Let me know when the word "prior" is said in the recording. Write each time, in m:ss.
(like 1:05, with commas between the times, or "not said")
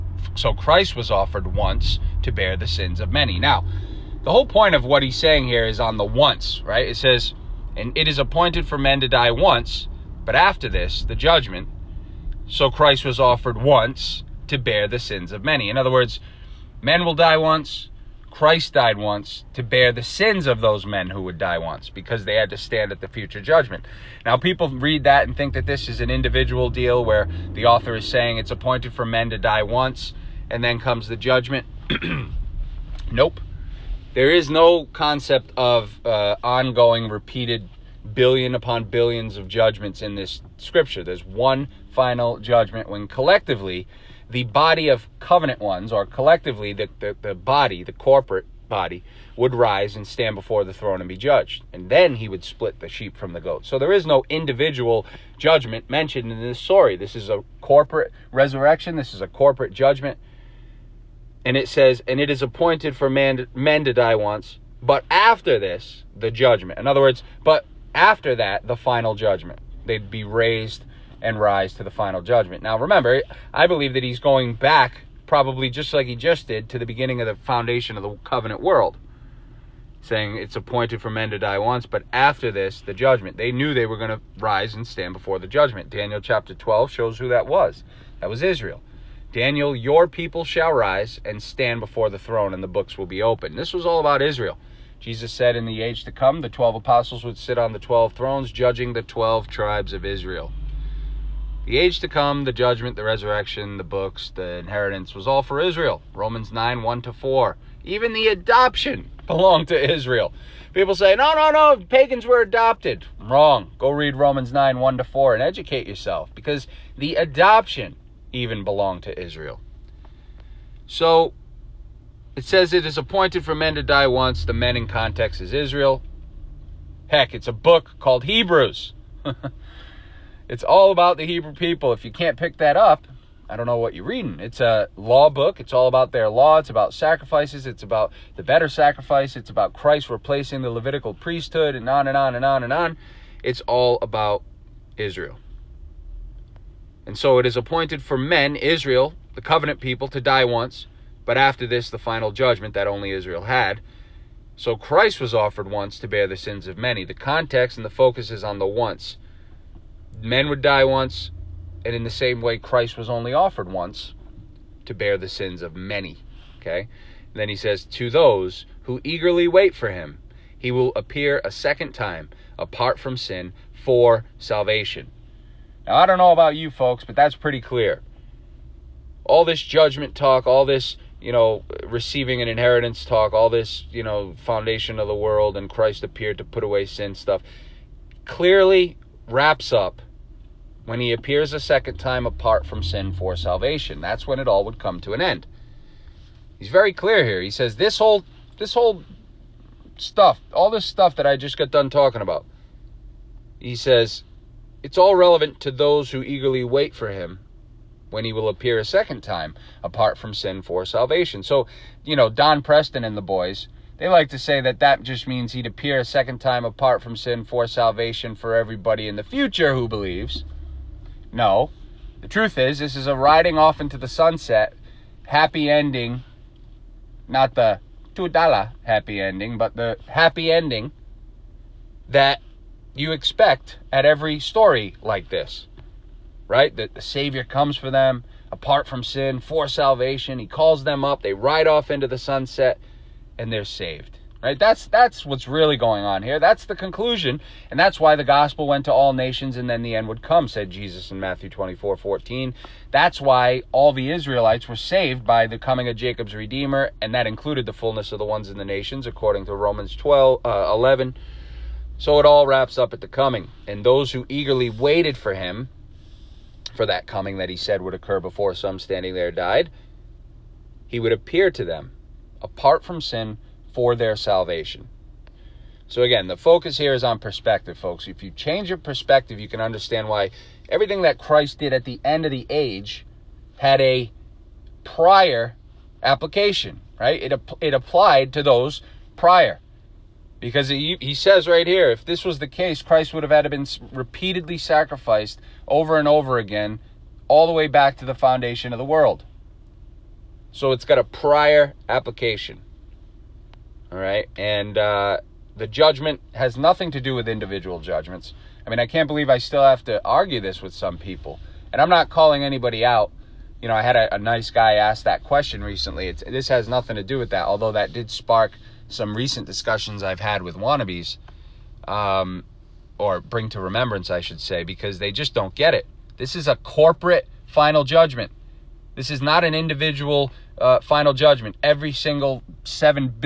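4:44, 4:49, 5:01.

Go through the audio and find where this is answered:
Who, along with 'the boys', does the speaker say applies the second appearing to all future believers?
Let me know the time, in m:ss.
3:32.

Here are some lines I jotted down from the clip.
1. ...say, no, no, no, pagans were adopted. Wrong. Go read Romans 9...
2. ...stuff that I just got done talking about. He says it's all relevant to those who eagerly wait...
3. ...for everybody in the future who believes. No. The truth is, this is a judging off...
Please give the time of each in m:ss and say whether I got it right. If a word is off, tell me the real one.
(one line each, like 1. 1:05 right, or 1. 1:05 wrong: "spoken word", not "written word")
1. 1:50 right
2. 3:20 right
3. 3:38 wrong: "riding", not "judging".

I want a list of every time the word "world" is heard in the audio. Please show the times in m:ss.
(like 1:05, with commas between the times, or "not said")
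1:18, 3:05, 4:58.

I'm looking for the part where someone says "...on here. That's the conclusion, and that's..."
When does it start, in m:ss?
4:06.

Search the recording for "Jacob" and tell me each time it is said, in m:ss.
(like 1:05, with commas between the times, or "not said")
4:15.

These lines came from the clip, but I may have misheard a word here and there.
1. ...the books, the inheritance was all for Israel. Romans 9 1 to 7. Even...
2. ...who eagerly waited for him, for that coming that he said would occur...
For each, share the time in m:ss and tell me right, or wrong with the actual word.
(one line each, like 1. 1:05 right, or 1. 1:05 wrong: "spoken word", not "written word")
1. 1:43 wrong: "4", not "7"
2. 4:24 right.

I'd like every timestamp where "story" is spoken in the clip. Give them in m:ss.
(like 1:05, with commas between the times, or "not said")
0:56, 3:54.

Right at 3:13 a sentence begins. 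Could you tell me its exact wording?
That's when it all would come to an end.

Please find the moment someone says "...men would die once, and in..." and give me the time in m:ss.
2:40.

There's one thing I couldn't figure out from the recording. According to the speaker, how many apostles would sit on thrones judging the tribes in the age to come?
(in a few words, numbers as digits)
12.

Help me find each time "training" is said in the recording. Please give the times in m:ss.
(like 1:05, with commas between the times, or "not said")
not said.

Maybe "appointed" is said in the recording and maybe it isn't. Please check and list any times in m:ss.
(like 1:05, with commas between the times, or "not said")
0:08, 0:28, 1:02, 1:20, 2:02, 2:27.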